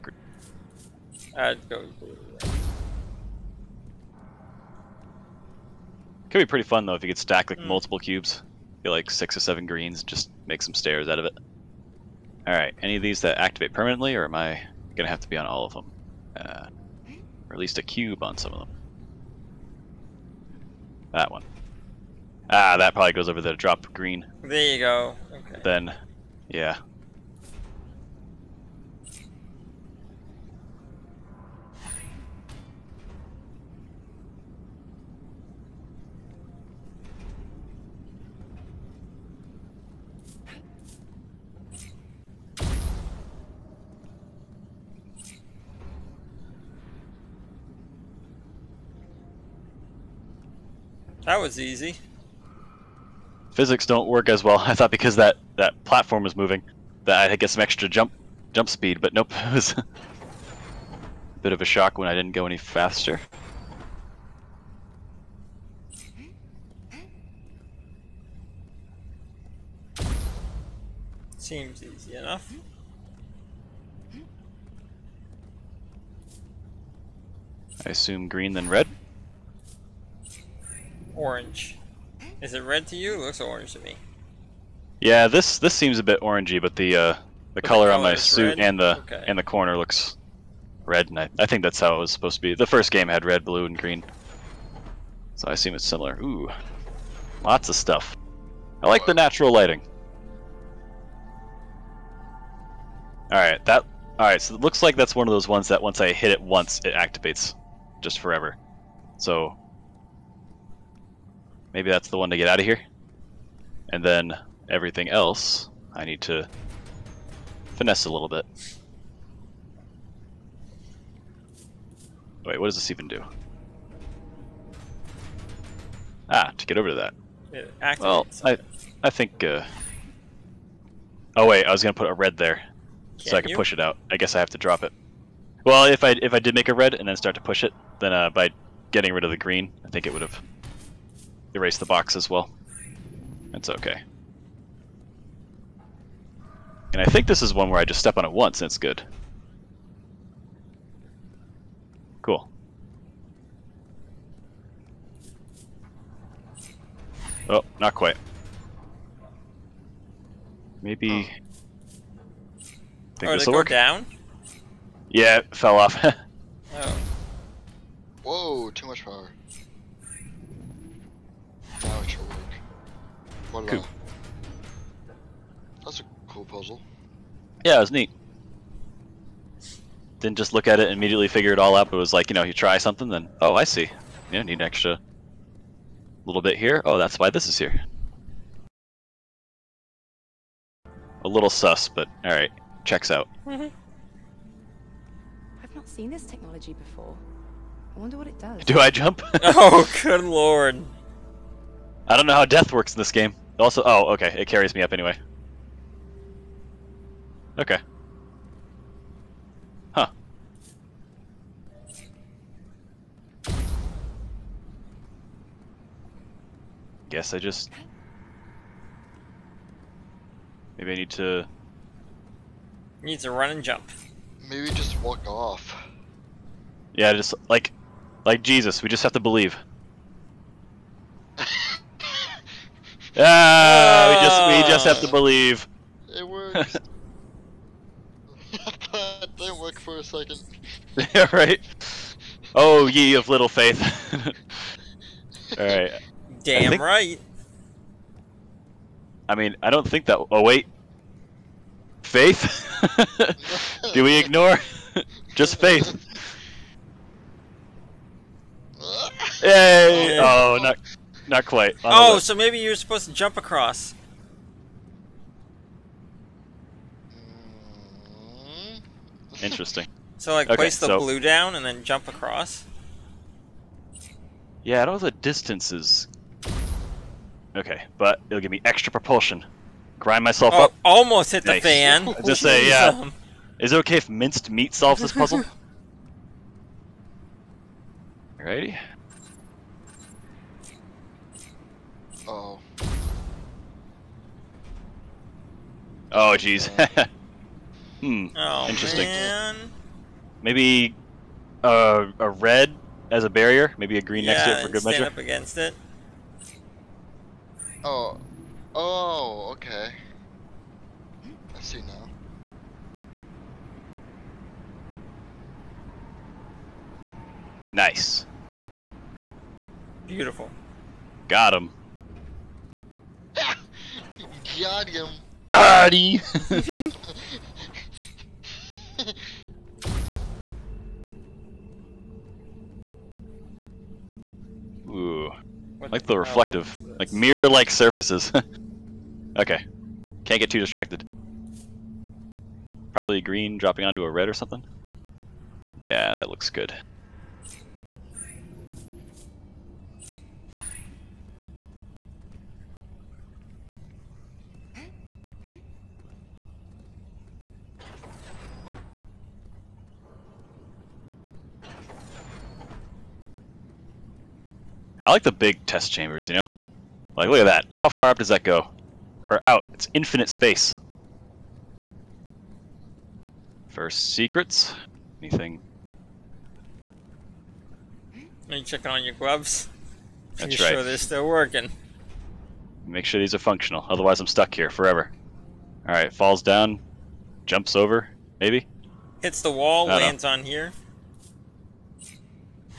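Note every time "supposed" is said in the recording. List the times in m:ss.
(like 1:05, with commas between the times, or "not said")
1:32, 4:22.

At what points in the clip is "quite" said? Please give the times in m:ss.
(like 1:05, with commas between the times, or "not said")
2:37, 4:21.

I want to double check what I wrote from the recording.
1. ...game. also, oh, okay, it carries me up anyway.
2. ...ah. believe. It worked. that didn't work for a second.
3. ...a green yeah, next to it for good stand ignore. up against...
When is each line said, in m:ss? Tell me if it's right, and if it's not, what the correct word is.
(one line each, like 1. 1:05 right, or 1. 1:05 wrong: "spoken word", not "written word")
1. 3:23 right
2. 3:55 right
3. 5:03 wrong: "measure", not "ignore".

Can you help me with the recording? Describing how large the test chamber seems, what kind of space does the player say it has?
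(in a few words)
infinite space.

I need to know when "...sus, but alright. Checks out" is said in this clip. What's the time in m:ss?
3:11.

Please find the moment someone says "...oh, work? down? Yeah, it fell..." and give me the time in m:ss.
2:43.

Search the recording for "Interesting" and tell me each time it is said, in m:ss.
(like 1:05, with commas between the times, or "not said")
4:29, 4:58.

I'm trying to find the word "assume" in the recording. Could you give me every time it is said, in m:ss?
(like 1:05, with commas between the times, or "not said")
1:17, 1:35.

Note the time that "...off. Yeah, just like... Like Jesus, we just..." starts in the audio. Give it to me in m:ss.
3:45.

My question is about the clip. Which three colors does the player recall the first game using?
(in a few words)
red, blue, and green.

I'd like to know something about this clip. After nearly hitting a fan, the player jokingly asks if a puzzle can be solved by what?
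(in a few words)
minced meat.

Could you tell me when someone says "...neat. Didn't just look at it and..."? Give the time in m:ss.
2:57.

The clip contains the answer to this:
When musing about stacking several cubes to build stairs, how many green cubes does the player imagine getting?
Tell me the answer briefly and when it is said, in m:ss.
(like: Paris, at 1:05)
six or seven, at 0:09.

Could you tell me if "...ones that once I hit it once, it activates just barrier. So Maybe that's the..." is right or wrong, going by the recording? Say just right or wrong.
wrong.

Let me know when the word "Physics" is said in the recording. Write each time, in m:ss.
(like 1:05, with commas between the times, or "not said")
0:53.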